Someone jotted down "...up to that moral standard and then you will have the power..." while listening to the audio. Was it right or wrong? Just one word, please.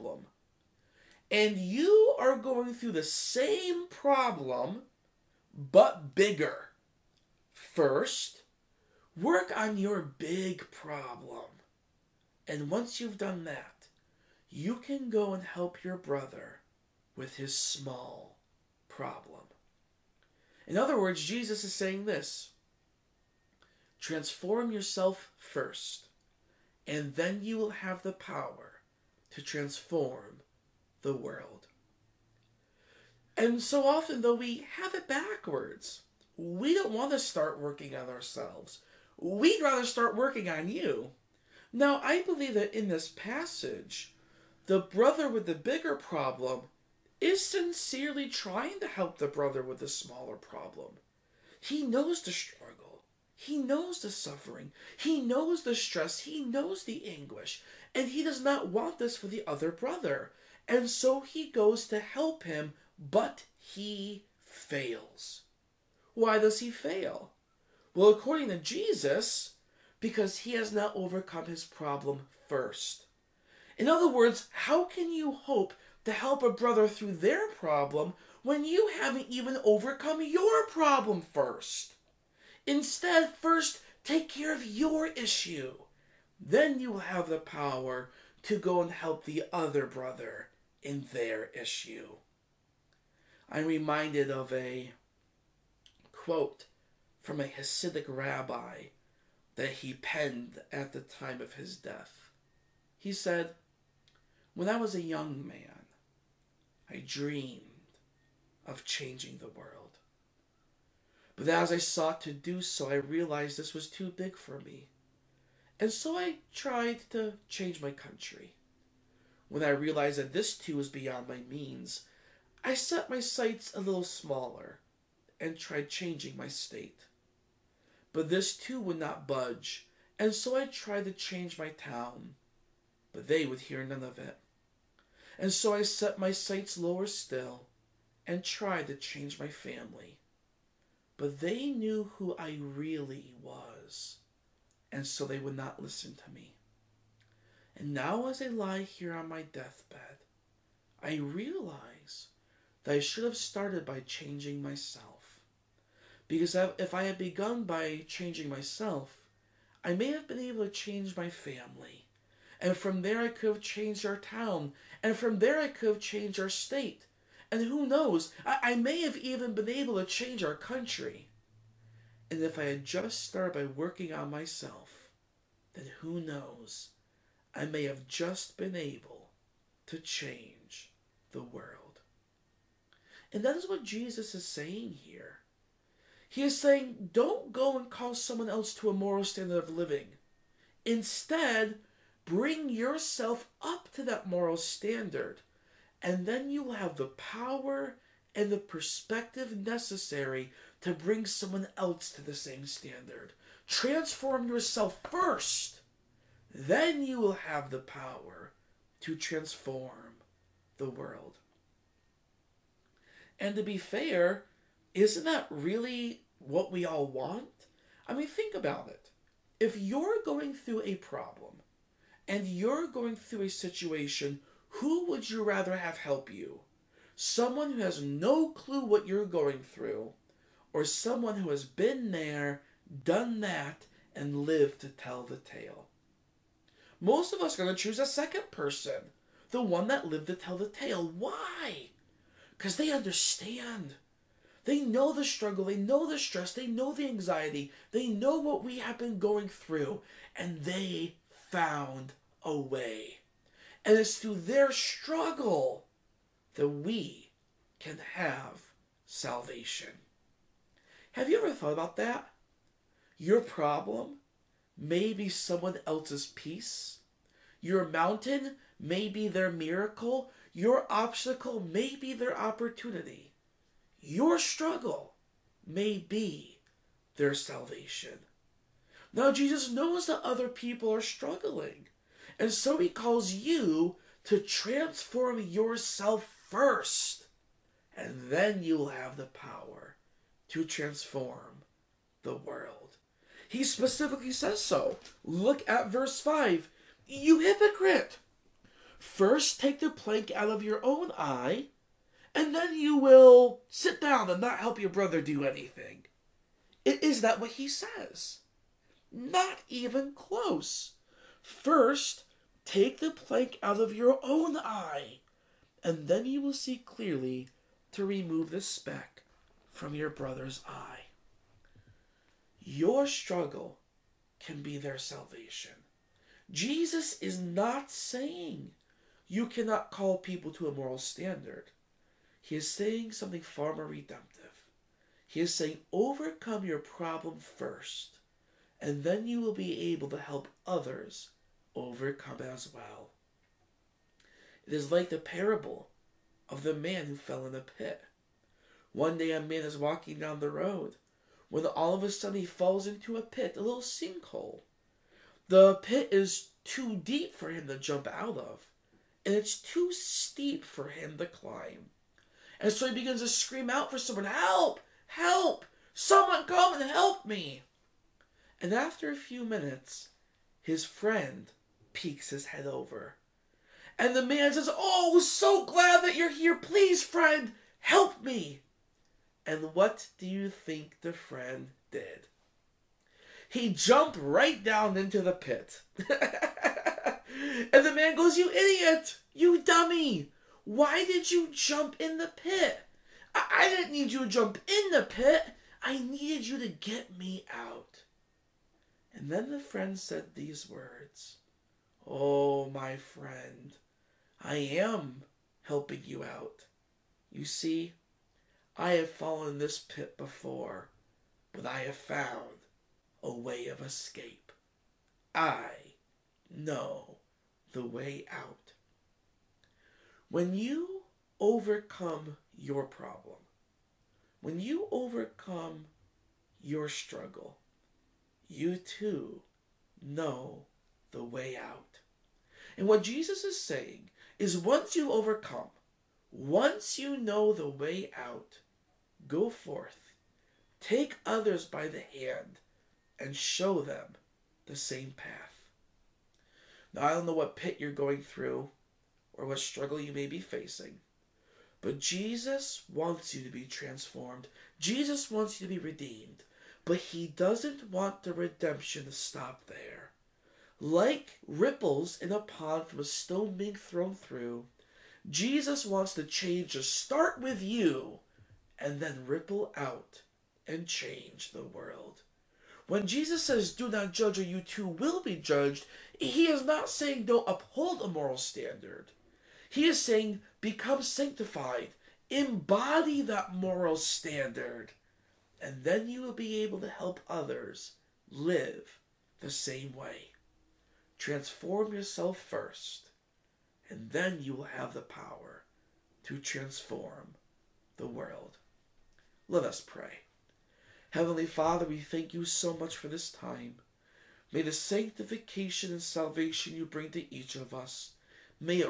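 right.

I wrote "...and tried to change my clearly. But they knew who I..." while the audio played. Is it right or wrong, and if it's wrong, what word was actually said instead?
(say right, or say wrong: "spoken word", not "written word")
wrong: "family", not "clearly".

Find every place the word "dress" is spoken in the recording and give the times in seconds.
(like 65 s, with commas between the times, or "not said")
not said.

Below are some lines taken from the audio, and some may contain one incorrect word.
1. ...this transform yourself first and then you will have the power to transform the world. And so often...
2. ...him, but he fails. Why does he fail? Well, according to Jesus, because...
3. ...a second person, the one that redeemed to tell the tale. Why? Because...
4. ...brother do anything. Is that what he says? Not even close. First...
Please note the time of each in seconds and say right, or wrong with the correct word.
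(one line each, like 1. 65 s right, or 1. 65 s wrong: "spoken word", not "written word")
1. 22 s right
2. 62 s right
3. 237 s wrong: "lived", not "redeemed"
4. 304 s right.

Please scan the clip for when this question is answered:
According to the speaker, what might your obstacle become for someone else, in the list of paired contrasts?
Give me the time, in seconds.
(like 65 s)
272 s.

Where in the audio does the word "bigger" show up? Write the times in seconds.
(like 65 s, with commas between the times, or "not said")
6 s, 45 s.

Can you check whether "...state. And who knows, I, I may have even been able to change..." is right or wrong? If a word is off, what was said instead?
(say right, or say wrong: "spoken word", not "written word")
right.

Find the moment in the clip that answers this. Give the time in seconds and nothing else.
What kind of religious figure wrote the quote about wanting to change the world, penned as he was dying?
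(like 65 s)
97 s.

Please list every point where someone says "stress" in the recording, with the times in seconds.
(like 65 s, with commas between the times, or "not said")
55 s, 246 s.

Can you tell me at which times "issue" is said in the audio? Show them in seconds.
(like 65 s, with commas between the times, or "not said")
85 s, 91 s.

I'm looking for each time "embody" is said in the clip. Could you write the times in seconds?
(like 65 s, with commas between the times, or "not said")
482 s.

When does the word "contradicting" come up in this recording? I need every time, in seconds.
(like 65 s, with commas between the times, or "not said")
not said.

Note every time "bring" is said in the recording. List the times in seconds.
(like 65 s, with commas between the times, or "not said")
192 s, 200 s, 506 s.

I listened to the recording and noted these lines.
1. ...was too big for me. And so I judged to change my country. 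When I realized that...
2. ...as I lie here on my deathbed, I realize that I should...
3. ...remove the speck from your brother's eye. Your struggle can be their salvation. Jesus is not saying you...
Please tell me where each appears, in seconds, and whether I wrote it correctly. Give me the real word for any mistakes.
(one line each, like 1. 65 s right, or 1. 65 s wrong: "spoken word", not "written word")
1. 113 s wrong: "tried", not "judged"
2. 148 s right
3. 318 s right.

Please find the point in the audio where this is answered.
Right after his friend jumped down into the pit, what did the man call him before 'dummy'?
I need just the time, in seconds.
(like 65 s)
388 s.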